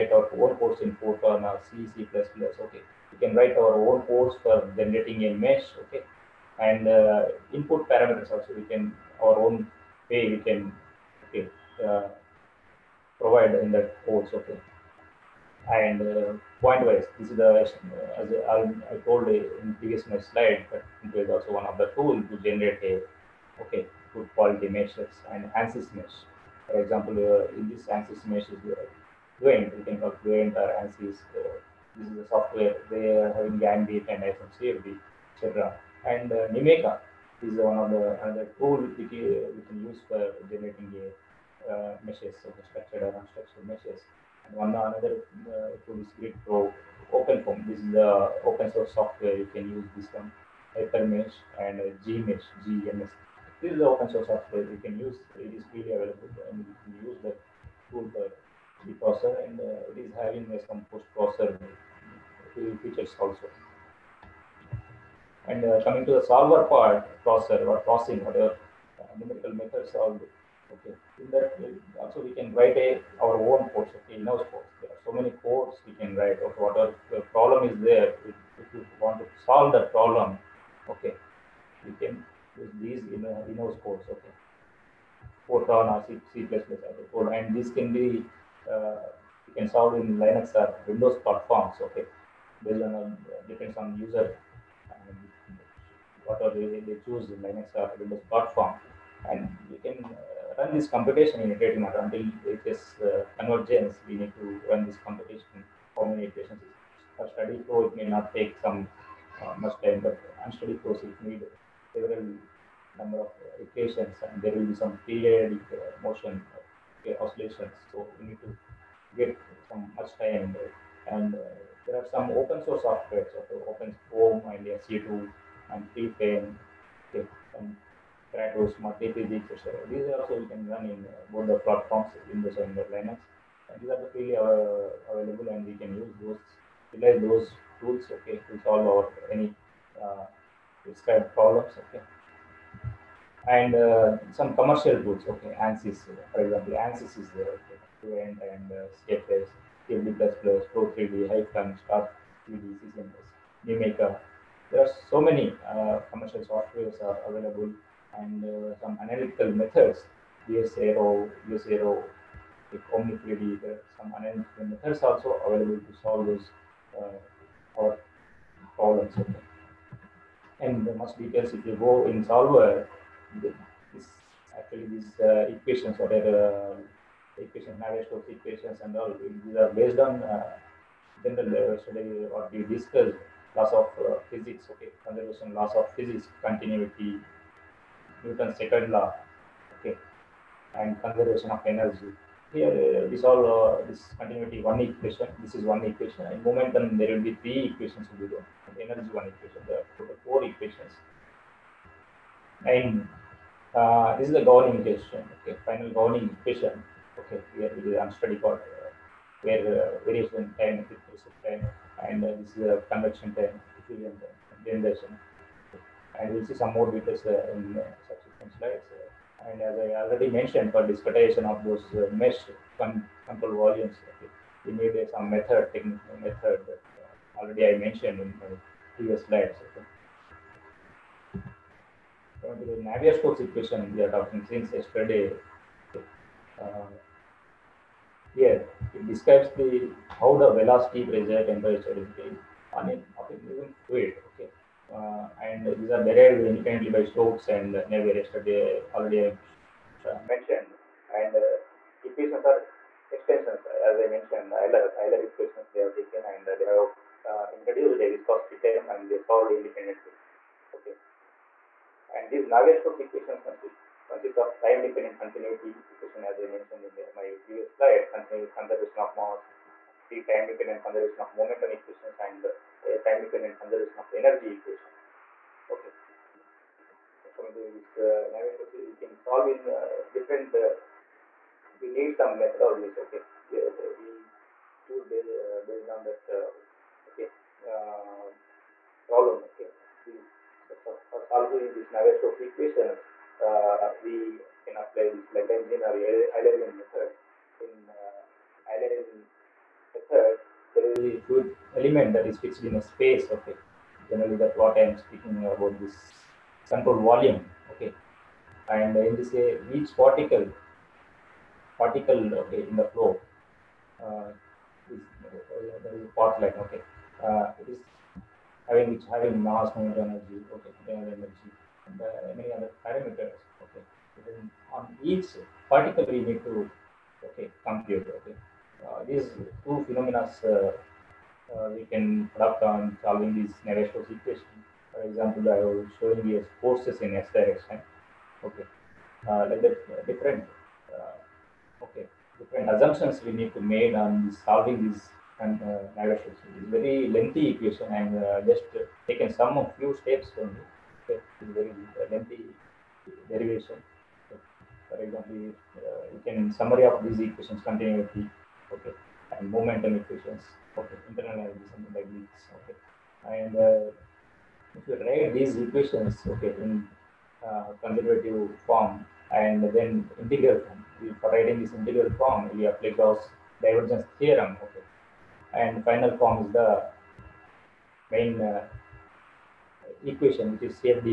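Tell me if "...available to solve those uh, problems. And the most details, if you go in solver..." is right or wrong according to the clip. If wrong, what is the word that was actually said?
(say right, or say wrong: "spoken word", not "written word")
right.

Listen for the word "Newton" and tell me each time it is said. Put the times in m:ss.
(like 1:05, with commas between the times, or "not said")
3:08.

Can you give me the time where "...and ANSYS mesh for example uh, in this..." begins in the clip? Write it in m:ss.
0:25.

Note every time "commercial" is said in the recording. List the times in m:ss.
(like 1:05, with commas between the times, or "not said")
2:24, 2:36.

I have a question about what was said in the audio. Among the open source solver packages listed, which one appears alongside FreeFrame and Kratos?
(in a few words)
SU2.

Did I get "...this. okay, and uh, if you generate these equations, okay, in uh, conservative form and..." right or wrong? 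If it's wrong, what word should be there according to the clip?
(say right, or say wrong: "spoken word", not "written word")
wrong: "write", not "generate".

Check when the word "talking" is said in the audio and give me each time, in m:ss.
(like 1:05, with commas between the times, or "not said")
3:54.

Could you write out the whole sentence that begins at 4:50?
These, so, so for solving these Navier-Stokes equations, we can apply this Lagrangian or Eulerian methods.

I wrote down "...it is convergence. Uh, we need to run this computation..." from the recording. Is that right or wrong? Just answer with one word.
right.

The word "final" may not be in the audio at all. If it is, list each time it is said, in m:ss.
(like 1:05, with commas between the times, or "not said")
3:25, 6:15.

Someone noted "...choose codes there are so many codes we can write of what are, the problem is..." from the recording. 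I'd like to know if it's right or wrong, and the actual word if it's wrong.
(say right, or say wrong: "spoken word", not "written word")
wrong: "house", not "choose".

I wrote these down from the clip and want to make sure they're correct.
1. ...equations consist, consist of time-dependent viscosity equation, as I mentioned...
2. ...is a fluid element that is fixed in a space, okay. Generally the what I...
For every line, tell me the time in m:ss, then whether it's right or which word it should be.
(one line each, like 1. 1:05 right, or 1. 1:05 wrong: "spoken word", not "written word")
1. 4:22 wrong: "continuity", not "viscosity"
2. 5:00 right.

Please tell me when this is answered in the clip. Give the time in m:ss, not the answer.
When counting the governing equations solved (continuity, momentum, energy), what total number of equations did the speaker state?
3:20.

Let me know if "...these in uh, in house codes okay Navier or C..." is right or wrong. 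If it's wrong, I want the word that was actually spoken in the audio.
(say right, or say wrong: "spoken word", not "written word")
wrong: "Fortran", not "Navier".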